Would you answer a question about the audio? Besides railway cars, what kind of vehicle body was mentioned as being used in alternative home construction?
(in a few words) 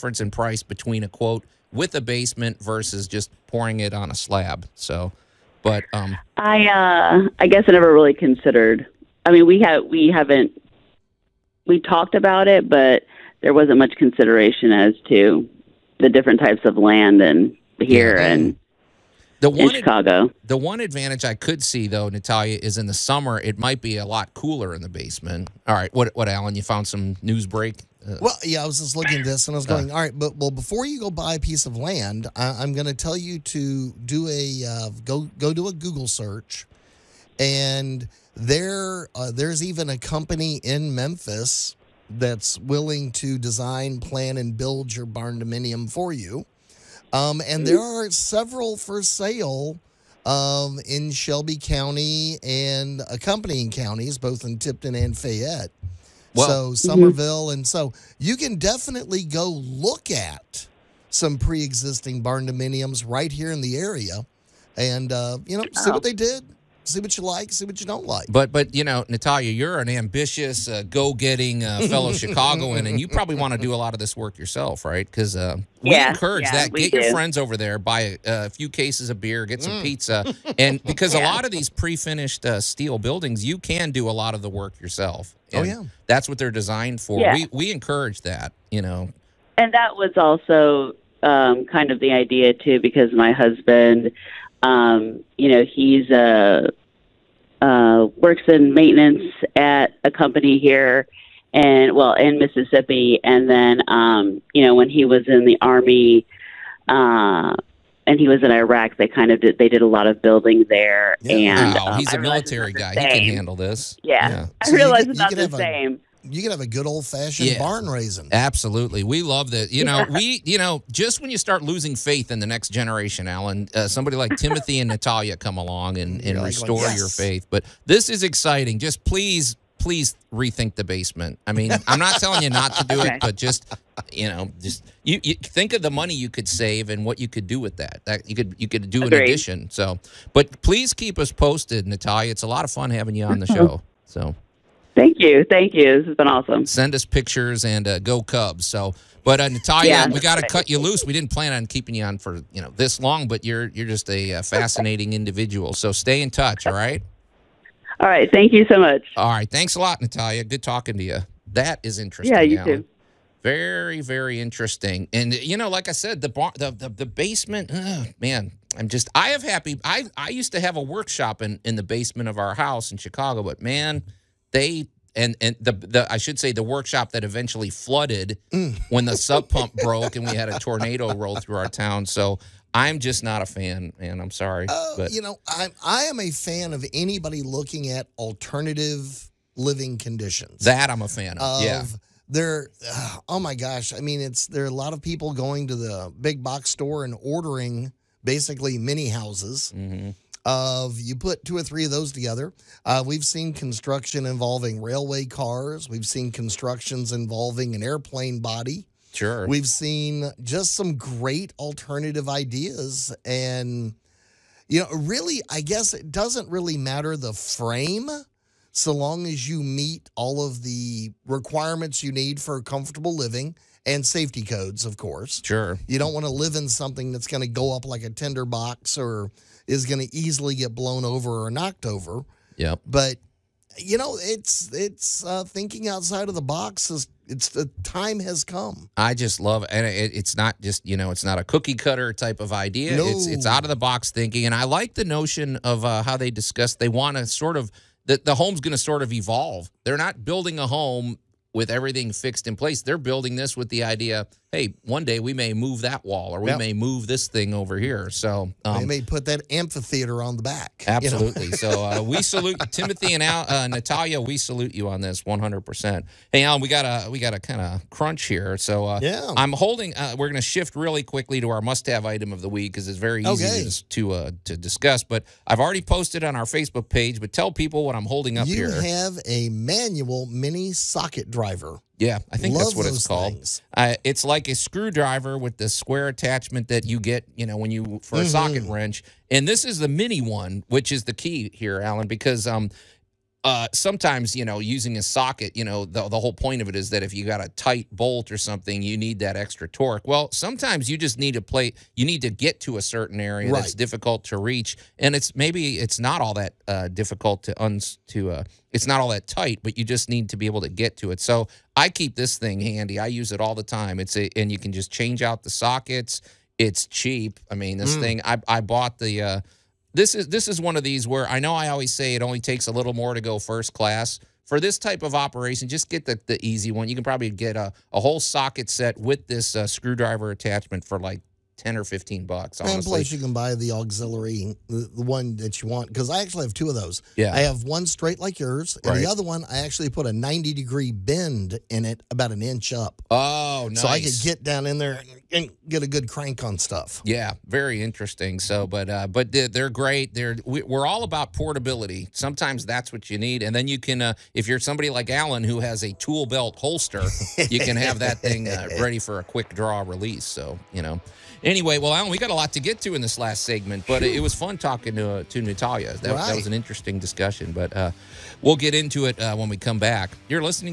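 An airplane body.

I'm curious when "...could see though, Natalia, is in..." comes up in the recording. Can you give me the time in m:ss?
0:21.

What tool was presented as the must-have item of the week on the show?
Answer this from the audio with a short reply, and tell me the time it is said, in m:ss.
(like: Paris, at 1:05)
Manual mini socket driver, at 4:39.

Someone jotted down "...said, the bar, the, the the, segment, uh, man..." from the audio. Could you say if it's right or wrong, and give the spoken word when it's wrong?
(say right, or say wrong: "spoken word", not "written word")
wrong: "basement", not "segment".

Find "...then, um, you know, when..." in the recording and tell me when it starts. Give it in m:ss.
1:43.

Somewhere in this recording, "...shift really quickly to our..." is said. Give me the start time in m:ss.
4:30.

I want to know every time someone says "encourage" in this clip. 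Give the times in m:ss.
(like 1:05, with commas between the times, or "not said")
1:16, 1:27.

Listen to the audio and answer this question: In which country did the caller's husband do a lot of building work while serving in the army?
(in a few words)
Iraq.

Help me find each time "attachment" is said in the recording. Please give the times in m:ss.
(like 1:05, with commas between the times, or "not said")
4:46, 5:30.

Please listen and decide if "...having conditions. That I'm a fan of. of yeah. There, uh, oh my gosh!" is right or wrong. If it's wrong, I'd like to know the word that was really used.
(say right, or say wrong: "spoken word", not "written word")
wrong: "living", not "having".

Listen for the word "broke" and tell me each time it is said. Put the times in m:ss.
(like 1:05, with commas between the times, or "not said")
2:59.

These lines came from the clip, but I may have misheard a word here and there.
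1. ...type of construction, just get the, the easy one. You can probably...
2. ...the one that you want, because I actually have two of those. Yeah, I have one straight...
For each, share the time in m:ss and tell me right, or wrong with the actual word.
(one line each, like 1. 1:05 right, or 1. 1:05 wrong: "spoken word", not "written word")
1. 5:24 wrong: "operation", not "construction"
2. 5:34 right.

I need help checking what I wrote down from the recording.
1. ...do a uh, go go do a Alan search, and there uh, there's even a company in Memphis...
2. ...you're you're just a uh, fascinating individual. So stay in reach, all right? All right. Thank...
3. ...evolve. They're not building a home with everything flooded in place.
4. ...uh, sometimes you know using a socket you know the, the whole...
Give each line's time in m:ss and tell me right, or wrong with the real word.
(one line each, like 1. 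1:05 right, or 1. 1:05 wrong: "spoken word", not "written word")
1. 0:34 wrong: "Google", not "Alan"
2. 2:33 wrong: "touch", not "reach"
3. 4:09 wrong: "fixed", not "flooded"
4. 4:53 right.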